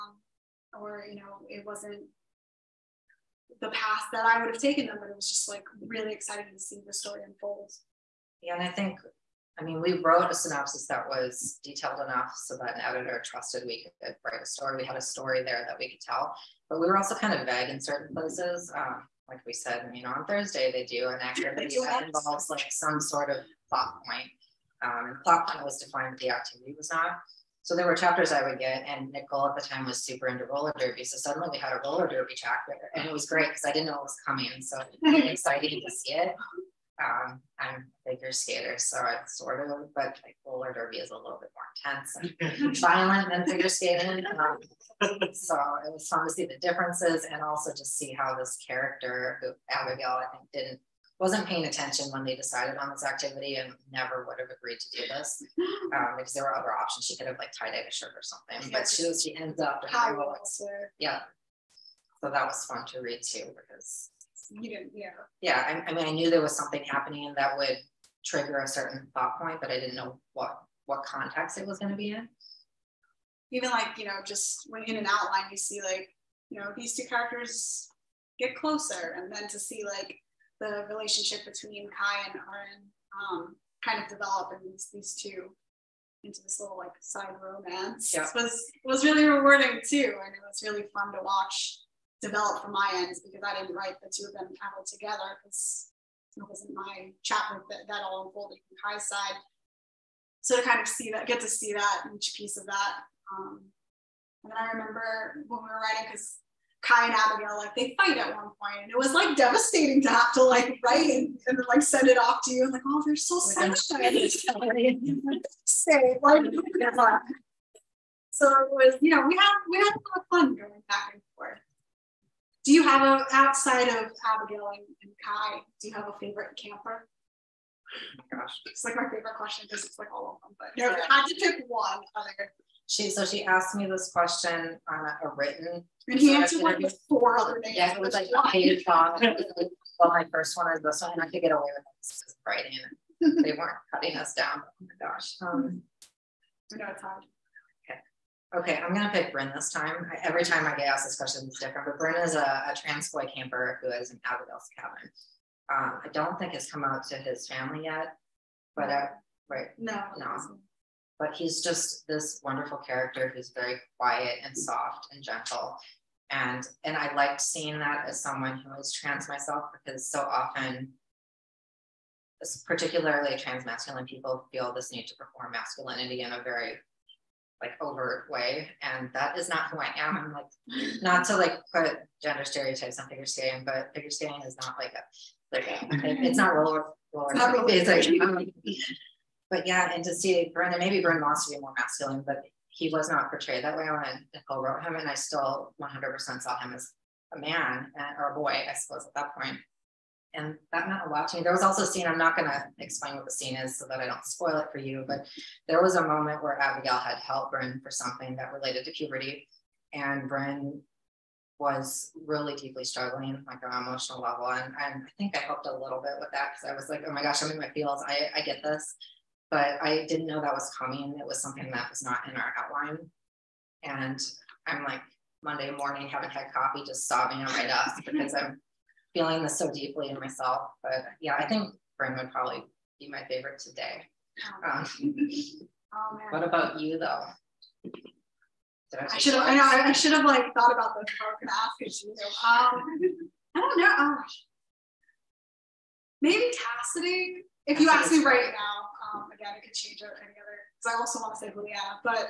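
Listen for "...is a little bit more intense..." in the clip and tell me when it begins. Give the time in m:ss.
0:40.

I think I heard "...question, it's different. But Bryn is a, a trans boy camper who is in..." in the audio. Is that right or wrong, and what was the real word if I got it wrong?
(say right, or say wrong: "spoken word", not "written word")
right.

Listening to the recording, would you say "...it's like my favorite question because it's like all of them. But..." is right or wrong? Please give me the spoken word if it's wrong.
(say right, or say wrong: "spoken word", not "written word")
right.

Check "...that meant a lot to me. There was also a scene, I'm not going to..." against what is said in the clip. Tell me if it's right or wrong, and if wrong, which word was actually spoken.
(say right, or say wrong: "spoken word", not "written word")
right.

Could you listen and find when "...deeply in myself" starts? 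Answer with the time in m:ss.
3:49.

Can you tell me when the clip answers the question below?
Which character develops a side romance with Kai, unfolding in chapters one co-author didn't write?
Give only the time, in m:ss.
1:22.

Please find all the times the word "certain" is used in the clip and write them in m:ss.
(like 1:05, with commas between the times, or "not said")
0:17, 1:08.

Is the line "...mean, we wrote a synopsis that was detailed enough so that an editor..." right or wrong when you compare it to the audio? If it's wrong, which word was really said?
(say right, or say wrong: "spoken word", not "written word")
right.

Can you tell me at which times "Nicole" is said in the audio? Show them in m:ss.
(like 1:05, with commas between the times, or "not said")
0:29, 3:14.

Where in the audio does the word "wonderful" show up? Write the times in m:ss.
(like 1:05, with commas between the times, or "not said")
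2:42.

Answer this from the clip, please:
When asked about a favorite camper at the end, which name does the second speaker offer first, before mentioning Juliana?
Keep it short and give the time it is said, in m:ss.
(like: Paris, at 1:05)
Cassidy, at 4:06.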